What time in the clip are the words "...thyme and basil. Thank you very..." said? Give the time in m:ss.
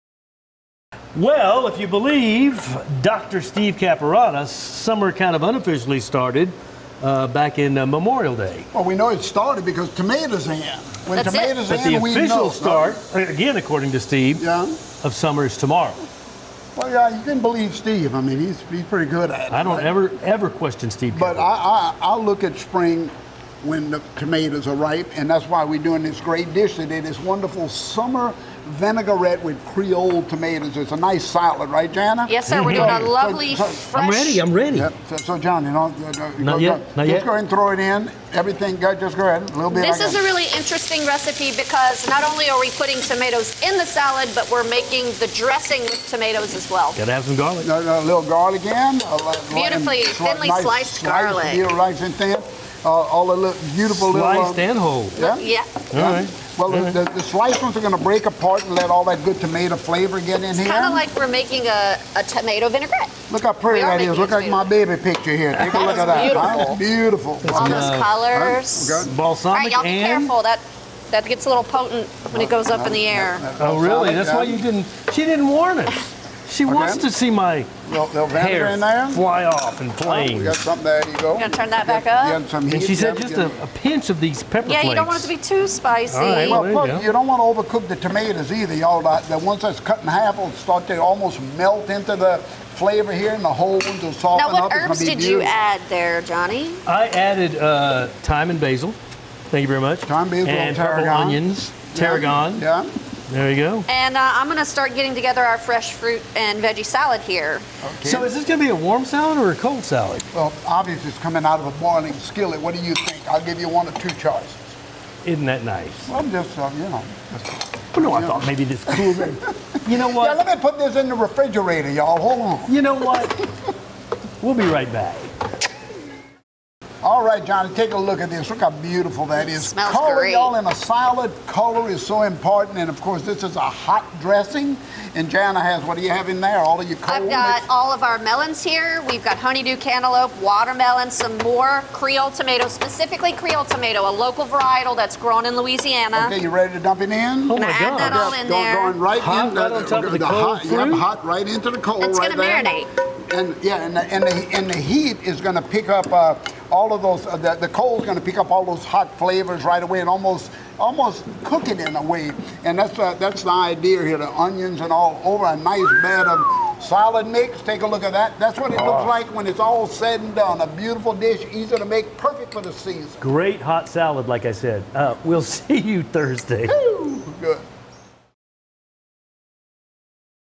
1:38.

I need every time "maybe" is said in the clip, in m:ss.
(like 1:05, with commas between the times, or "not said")
1:58.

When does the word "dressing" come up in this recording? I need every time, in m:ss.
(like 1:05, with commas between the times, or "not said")
0:45, 2:14.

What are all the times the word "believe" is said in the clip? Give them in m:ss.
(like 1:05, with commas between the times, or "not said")
0:01, 0:17.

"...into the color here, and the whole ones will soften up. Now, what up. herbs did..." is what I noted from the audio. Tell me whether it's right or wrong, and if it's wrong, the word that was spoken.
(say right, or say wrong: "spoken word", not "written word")
wrong: "flavor", not "color".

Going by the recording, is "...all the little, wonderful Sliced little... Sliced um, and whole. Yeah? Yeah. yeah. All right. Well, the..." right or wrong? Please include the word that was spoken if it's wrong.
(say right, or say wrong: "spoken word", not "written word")
wrong: "beautiful", not "wonderful".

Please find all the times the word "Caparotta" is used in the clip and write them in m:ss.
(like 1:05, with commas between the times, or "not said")
0:03, 0:21.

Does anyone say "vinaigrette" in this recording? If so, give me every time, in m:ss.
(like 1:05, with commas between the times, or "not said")
0:28, 1:02.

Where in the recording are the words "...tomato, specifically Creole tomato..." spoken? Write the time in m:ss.
2:22.